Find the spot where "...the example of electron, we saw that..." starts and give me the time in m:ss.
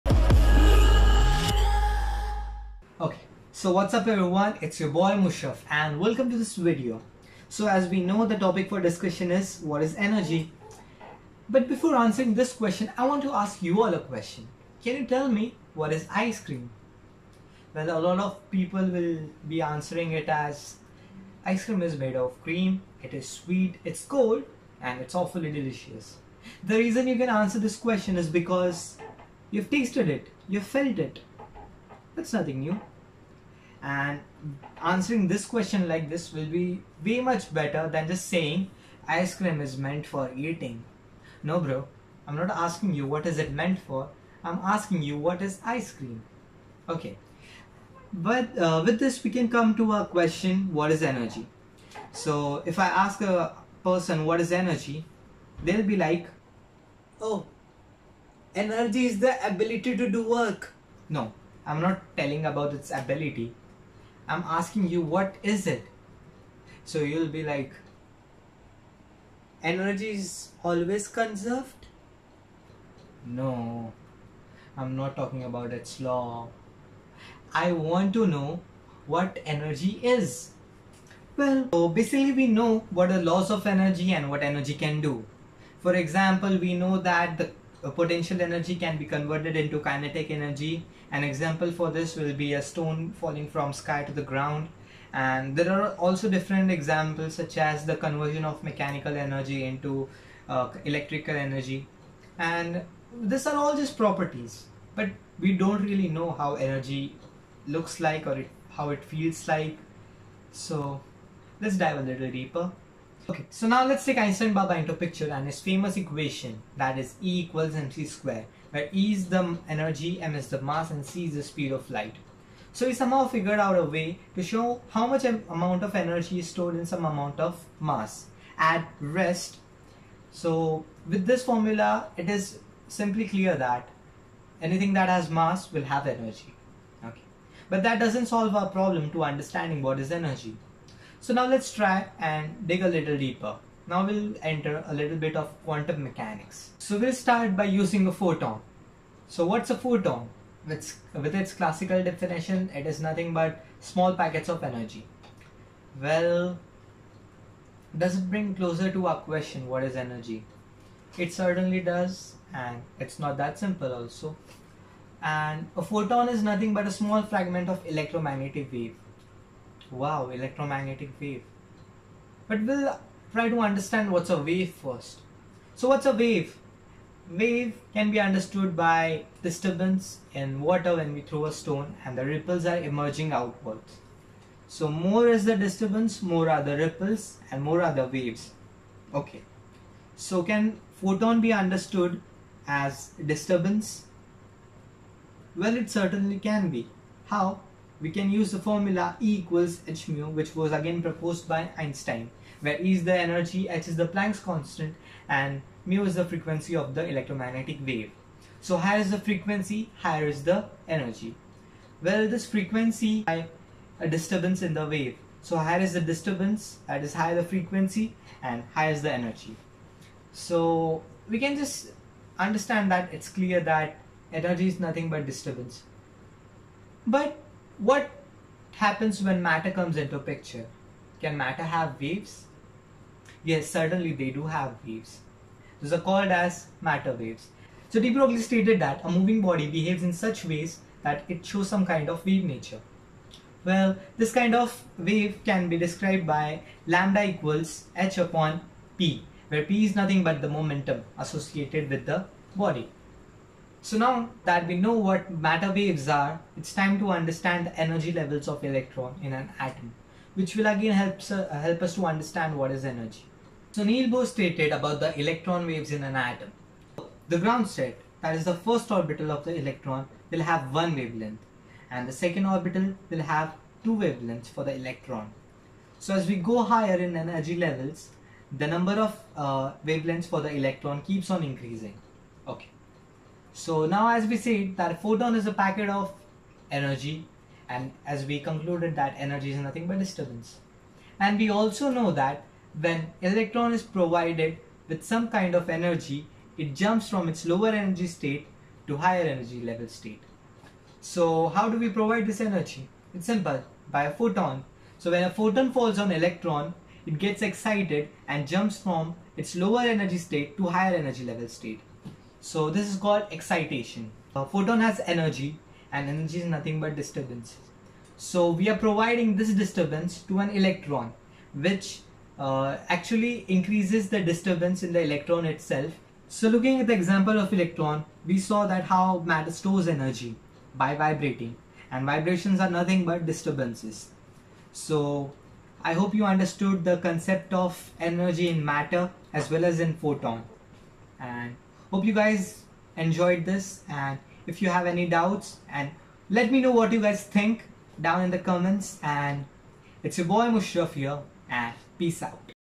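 5:26.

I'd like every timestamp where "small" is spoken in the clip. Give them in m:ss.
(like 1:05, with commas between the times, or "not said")
2:33, 2:46.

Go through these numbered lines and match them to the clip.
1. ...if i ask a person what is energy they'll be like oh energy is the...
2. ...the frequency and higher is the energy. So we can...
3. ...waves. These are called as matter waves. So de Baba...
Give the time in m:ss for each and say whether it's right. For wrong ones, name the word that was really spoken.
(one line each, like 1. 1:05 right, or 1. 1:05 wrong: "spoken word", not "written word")
1. 0:52 right
2. 3:37 right
3. 3:54 wrong: "Broglie", not "Baba".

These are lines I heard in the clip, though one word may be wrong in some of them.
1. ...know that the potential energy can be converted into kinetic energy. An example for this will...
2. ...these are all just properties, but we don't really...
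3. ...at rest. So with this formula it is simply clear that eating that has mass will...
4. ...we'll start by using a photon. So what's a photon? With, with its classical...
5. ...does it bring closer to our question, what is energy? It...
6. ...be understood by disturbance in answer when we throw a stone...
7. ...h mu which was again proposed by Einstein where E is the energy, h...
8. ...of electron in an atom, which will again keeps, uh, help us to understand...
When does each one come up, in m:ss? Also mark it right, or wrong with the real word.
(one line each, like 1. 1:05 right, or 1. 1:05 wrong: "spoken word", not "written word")
1. 1:26 right
2. 1:43 right
3. 2:08 wrong: "anything", not "eating"
4. 2:26 right
5. 2:37 right
6. 2:58 wrong: "water", not "answer"
7. 3:19 right
8. 4:18 wrong: "helps", not "keeps".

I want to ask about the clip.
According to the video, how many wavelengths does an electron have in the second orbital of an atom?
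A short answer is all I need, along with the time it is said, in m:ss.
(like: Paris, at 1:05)
2, at 4:33.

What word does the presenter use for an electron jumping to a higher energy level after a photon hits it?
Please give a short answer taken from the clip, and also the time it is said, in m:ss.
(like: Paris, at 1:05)
Excitation, at 5:13.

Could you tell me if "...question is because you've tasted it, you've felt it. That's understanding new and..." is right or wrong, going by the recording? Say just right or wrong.
wrong.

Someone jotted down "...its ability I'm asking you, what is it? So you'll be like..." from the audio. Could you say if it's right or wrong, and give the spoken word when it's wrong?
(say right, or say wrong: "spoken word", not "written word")
right.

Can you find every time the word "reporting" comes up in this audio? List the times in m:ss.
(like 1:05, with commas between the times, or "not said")
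not said.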